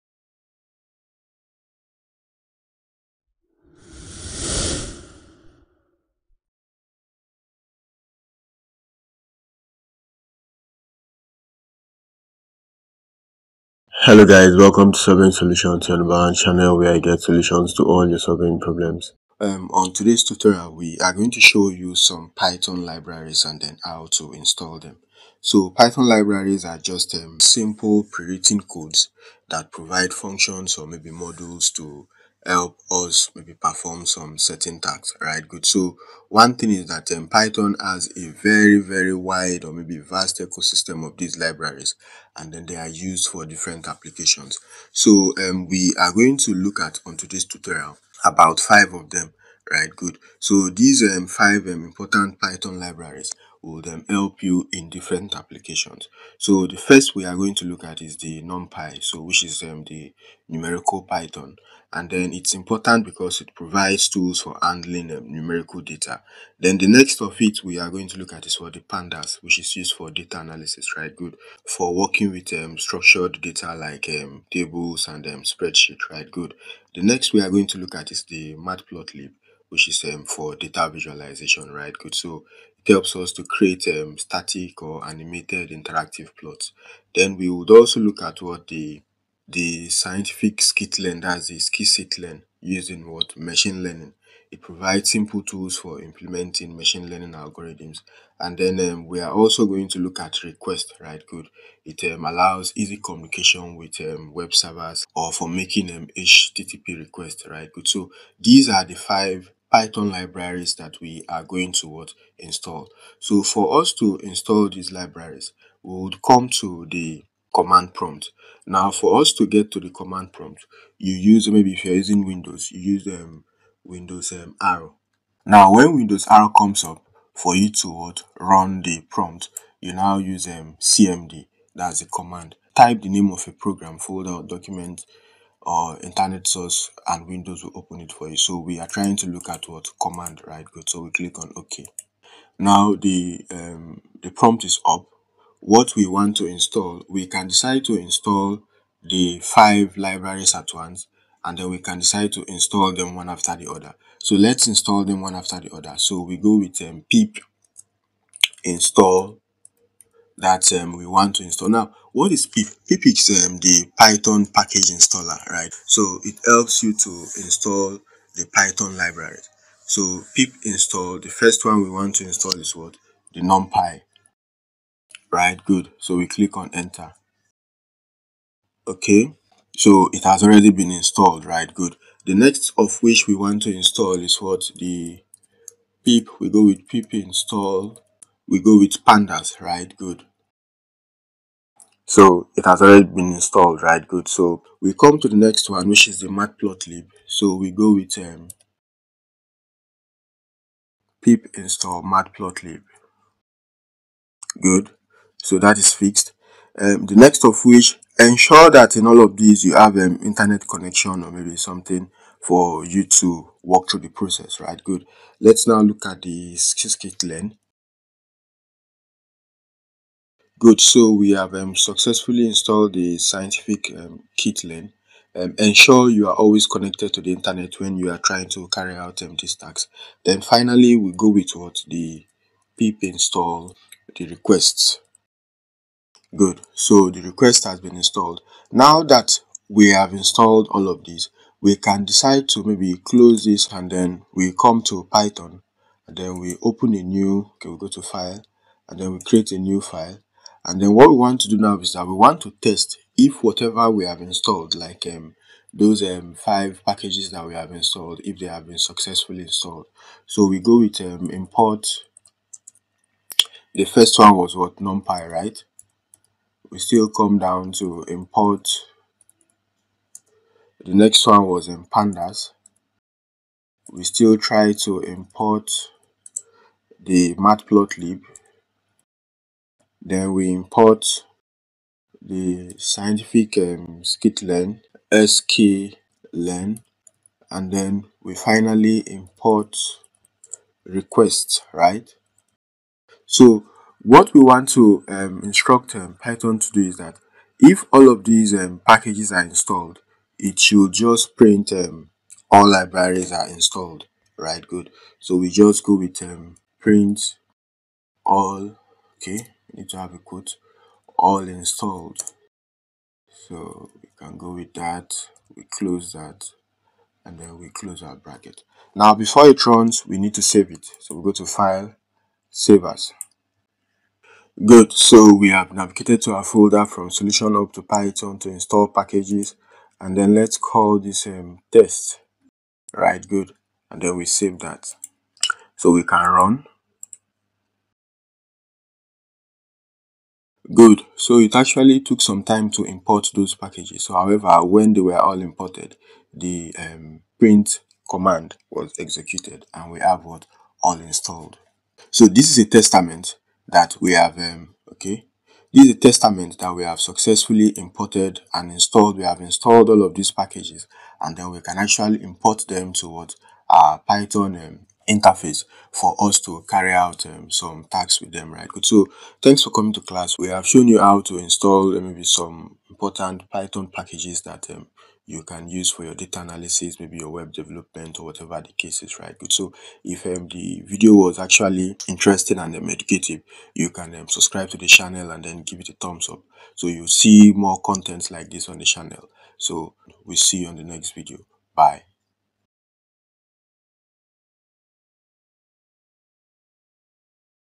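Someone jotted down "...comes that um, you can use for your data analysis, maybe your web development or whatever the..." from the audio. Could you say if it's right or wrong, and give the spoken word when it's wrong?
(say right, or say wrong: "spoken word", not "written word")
wrong: "packages", not "comes".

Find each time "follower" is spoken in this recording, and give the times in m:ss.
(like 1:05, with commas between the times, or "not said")
not said.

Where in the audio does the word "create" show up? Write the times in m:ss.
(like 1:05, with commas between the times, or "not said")
1:23, 4:09.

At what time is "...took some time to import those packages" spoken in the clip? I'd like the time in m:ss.
5:42.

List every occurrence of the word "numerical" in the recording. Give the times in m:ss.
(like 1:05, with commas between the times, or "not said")
1:00, 1:05.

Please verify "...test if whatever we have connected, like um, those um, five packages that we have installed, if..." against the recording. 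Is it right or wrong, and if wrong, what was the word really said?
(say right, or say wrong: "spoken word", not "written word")
wrong: "installed", not "connected".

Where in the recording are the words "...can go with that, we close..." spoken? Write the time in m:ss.
5:14.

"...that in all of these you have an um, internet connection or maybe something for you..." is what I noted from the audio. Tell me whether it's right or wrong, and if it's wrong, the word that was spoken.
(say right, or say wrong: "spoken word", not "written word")
right.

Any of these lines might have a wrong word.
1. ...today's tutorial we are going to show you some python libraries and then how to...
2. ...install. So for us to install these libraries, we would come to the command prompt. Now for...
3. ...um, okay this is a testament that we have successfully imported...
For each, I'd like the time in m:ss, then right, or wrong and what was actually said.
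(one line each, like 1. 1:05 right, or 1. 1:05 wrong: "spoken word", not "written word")
1. 0:19 right
2. 1:52 right
3. 5:54 right.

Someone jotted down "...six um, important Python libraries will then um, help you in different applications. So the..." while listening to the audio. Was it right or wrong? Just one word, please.
wrong.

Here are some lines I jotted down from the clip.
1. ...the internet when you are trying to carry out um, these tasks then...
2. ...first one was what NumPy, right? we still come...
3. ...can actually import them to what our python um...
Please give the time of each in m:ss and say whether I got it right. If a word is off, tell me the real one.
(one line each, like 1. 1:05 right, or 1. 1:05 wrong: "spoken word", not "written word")
1. 3:47 right
2. 4:23 right
3. 6:01 right.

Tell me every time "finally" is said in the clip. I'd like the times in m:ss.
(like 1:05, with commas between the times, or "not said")
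3:50, 4:48.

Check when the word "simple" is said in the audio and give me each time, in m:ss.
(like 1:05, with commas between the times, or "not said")
0:27, 1:35.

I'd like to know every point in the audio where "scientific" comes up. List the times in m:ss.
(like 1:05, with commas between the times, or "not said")
1:29, 3:43, 4:42.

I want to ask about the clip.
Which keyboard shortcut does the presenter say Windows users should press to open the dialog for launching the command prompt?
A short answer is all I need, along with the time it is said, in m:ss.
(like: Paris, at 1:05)
Windows R, at 2:05.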